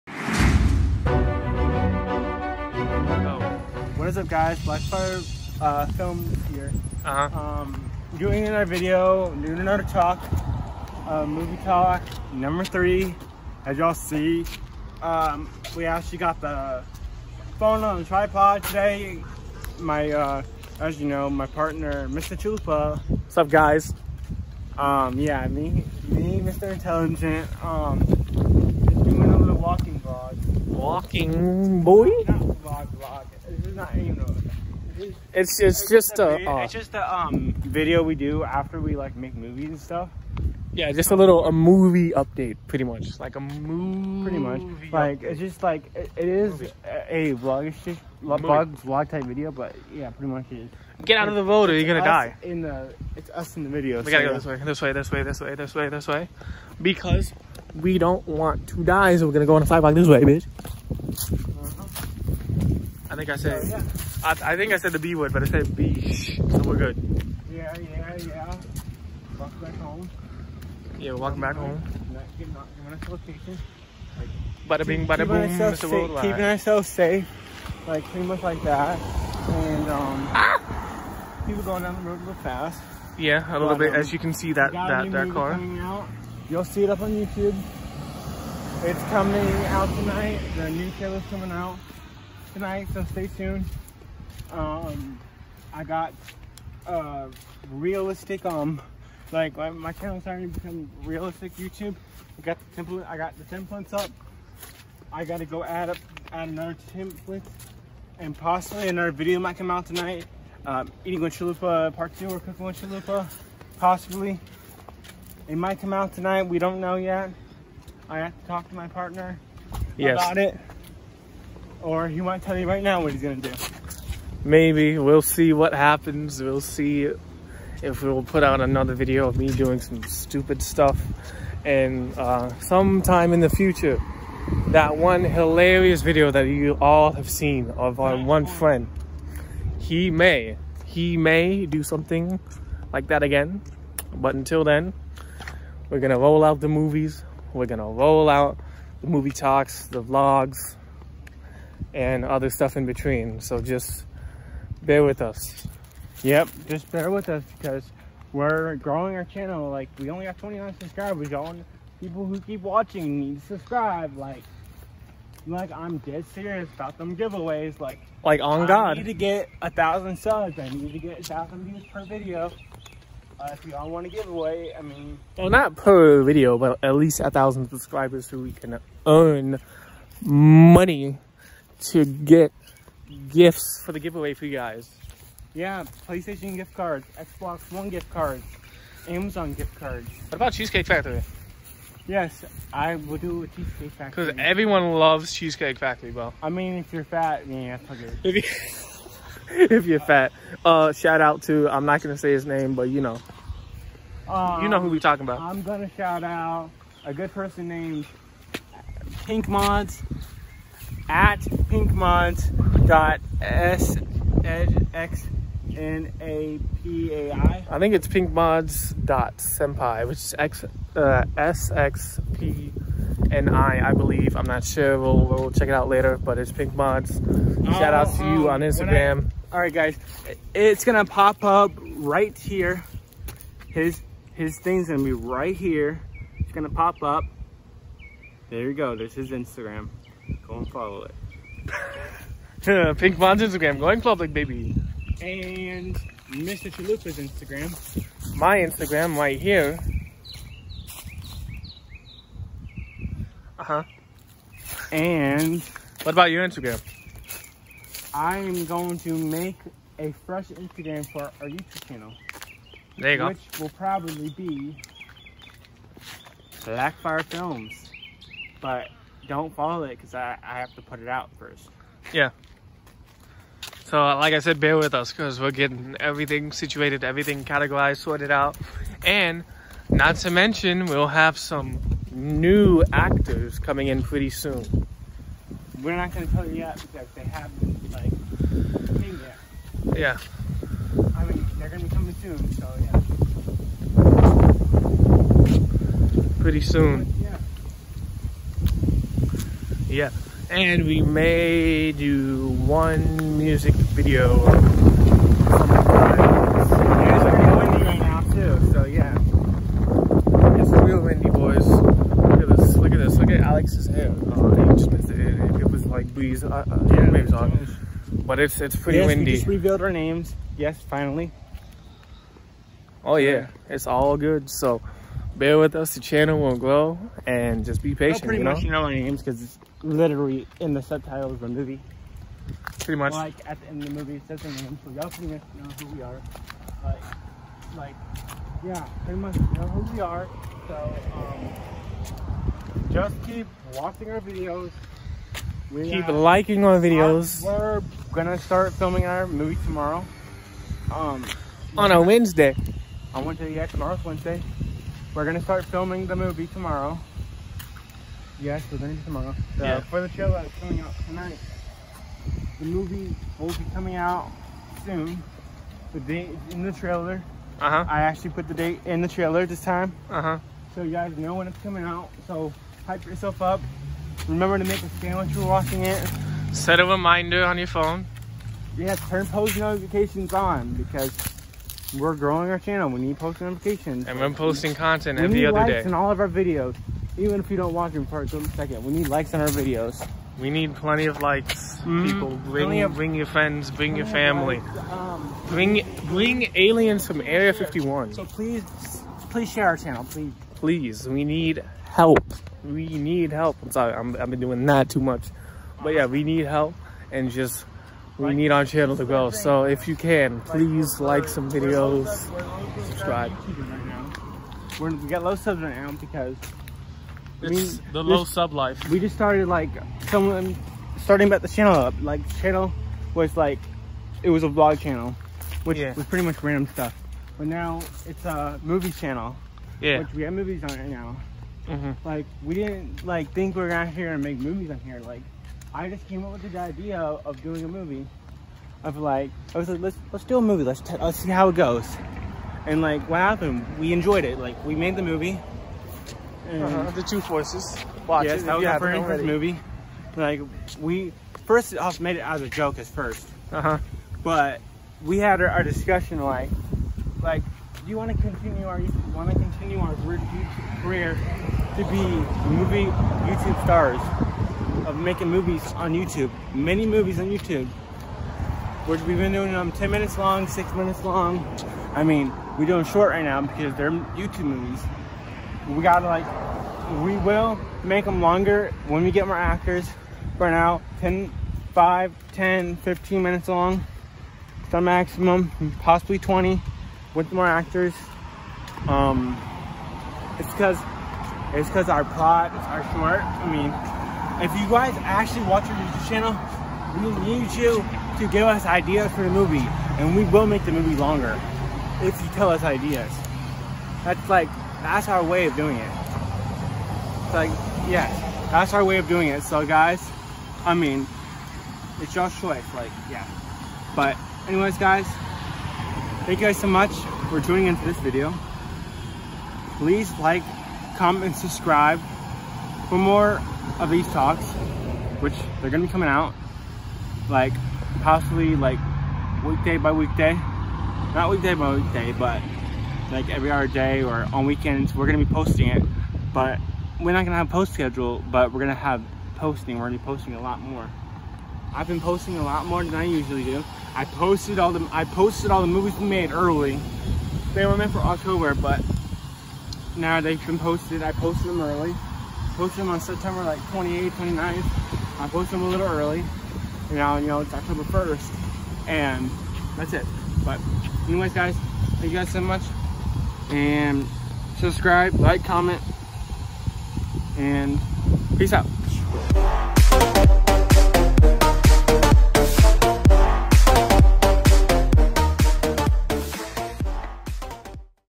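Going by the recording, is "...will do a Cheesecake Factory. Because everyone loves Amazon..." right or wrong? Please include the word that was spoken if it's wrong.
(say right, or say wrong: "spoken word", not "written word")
wrong: "Cheesecake", not "Amazon".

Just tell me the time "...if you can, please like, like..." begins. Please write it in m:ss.
6:49.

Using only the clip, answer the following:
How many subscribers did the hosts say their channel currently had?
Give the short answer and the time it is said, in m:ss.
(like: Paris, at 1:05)
29, at 2:40.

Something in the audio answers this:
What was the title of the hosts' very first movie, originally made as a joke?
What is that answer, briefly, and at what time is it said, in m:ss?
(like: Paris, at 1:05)
The Two Forces, at 7:26.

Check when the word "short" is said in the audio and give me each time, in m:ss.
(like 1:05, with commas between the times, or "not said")
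7:52, 8:12.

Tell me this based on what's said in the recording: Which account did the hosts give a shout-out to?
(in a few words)
Pink Mods.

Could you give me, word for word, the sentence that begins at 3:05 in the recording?
Yeah, PlayStation gift cards, Xbox One gift cards, Amazon gift cards.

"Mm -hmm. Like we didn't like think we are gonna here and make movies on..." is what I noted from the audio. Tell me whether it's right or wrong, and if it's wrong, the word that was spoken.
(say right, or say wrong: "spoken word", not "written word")
right.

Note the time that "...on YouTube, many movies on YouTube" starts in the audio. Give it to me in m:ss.
7:45.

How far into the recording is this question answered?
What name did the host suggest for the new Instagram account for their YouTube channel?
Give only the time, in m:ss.
4:26.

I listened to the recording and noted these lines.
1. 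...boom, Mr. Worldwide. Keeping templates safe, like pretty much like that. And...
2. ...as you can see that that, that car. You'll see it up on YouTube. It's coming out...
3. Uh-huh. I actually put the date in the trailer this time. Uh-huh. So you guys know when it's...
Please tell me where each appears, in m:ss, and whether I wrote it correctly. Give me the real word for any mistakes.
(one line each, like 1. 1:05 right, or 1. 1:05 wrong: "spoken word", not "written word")
1. 1:15 wrong: "ourselves", not "templates"
2. 1:23 right
3. 6:07 right.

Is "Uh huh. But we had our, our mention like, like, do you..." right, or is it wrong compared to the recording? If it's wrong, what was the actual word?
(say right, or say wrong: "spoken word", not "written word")
wrong: "discussion", not "mention".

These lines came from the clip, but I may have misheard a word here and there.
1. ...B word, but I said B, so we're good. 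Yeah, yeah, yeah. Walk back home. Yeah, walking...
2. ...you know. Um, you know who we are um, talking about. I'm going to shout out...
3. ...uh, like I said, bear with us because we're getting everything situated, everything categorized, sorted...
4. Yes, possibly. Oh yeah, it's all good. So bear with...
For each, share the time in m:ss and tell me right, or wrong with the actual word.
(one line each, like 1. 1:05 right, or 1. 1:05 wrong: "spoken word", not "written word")
1. 1:04 right
2. 3:22 right
3. 4:34 right
4. 5:20 wrong: "finally", not "possibly".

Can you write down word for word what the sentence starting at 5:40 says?
So, um, just keep watching our videos.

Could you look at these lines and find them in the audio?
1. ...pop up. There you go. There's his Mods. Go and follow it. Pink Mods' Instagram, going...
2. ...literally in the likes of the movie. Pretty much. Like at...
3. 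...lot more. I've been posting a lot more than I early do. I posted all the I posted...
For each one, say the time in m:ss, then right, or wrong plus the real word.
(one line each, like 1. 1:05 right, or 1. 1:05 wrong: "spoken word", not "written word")
1. 3:56 wrong: "Instagram", not "Mods"
2. 5:29 wrong: "subtitles", not "likes"
3. 9:00 wrong: "usually", not "early".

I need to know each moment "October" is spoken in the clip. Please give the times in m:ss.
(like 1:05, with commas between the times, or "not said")
9:07, 9:17.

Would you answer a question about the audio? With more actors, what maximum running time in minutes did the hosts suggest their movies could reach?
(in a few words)
20.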